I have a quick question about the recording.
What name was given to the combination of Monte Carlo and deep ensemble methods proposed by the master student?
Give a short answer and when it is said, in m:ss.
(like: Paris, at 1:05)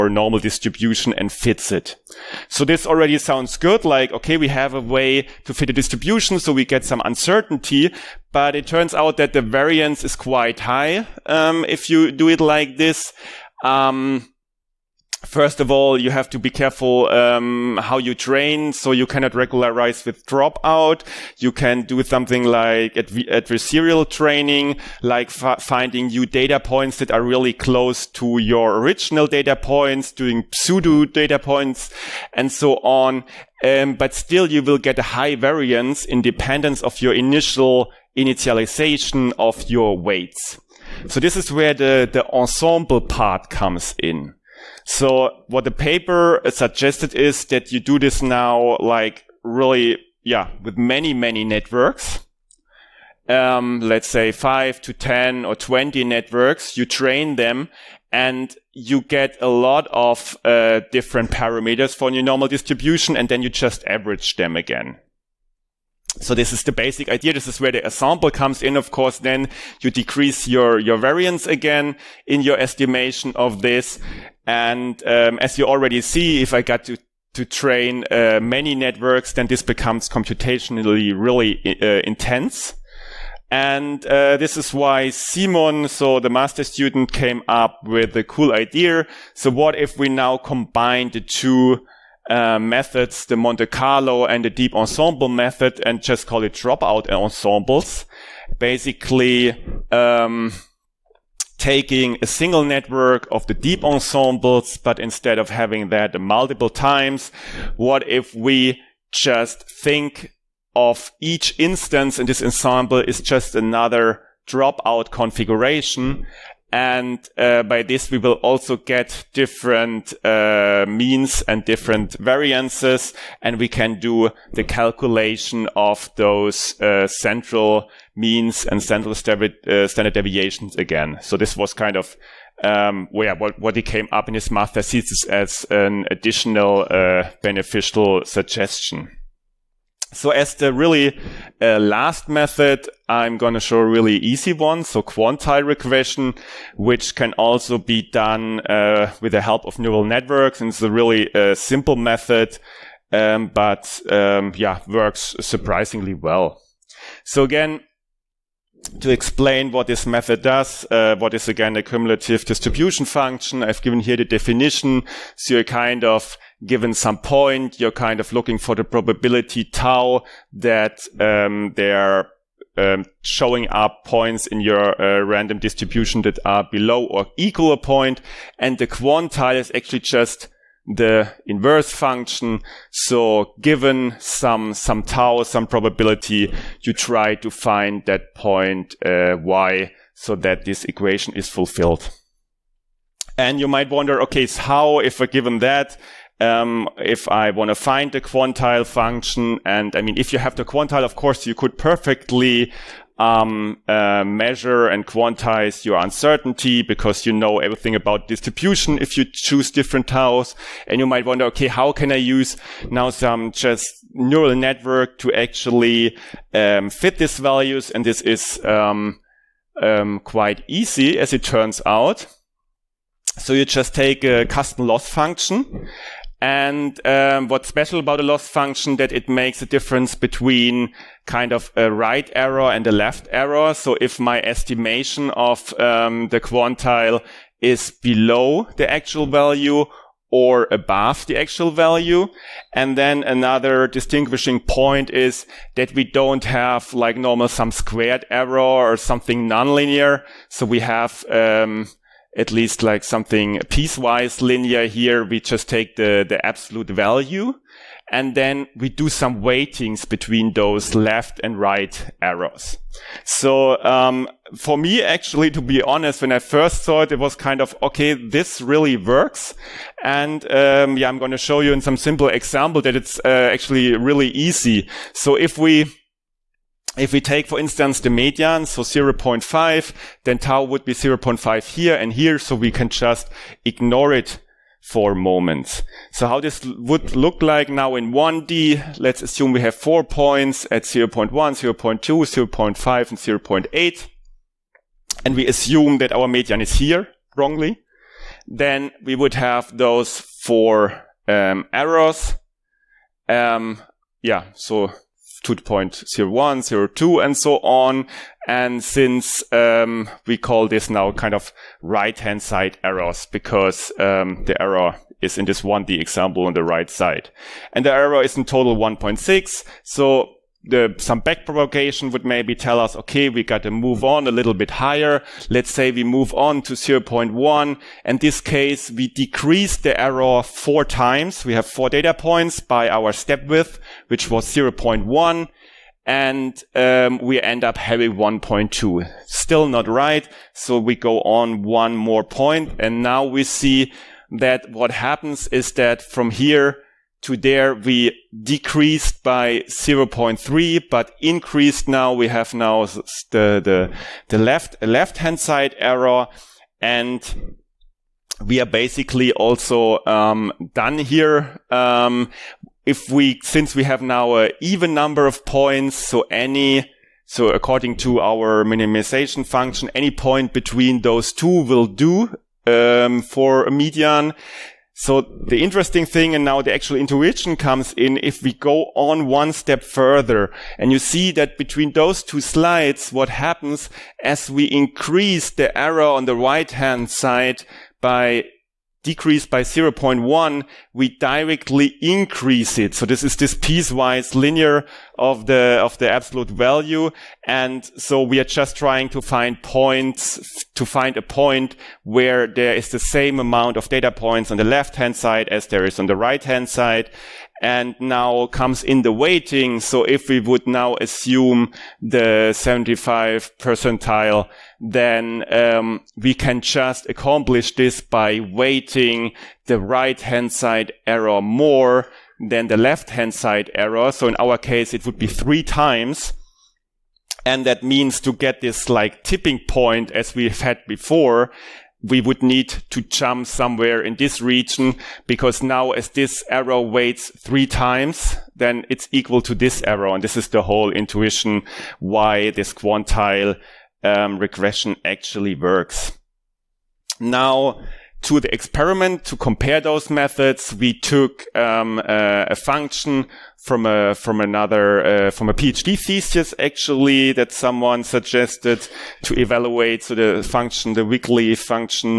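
dropout ensembles, at 1:36.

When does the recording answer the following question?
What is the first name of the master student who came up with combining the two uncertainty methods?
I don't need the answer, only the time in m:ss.
1:25.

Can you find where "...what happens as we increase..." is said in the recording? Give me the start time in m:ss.
6:23.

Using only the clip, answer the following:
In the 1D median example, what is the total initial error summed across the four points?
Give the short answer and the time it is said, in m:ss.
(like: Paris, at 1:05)
1.6, at 5:18.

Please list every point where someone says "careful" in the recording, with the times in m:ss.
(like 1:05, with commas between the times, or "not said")
0:16.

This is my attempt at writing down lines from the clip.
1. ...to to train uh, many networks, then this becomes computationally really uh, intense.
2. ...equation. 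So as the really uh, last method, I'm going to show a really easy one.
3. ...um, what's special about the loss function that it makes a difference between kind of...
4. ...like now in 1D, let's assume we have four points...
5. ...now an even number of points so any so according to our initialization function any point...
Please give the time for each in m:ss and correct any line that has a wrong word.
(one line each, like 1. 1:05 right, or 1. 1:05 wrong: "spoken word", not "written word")
1. 1:16 right
2. 2:18 wrong: "suggestion", not "equation"
3. 3:47 right
4. 4:47 right
5. 6:04 wrong: "minimization", not "initialization".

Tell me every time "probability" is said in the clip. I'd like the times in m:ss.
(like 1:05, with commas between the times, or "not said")
2:48, 3:05.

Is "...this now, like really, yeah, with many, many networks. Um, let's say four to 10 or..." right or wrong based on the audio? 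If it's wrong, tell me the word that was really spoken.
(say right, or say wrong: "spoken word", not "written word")
wrong: "five", not "four".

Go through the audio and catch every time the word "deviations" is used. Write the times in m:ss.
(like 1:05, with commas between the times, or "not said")
2:10.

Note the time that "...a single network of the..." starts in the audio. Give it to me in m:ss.
1:42.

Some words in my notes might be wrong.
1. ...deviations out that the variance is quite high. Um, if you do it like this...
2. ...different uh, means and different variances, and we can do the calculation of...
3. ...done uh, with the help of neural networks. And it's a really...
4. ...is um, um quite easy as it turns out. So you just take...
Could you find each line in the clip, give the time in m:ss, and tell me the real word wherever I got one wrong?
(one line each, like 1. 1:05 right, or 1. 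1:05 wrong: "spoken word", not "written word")
1. 0:08 wrong: "turns", not "deviations"
2. 1:59 right
3. 2:28 right
4. 3:38 right.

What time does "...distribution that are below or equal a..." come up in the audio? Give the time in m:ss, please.
2:55.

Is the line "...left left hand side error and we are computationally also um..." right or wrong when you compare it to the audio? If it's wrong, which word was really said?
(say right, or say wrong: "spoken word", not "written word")
wrong: "basically", not "computationally".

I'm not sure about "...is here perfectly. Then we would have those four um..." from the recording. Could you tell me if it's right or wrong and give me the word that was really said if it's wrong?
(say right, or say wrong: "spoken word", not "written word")
wrong: "wrongly", not "perfectly".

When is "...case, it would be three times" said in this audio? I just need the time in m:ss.
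7:04.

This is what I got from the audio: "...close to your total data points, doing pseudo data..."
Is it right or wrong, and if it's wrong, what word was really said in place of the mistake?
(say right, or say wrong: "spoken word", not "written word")
wrong: "original", not "total".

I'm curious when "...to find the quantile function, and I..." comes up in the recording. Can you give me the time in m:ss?
3:17.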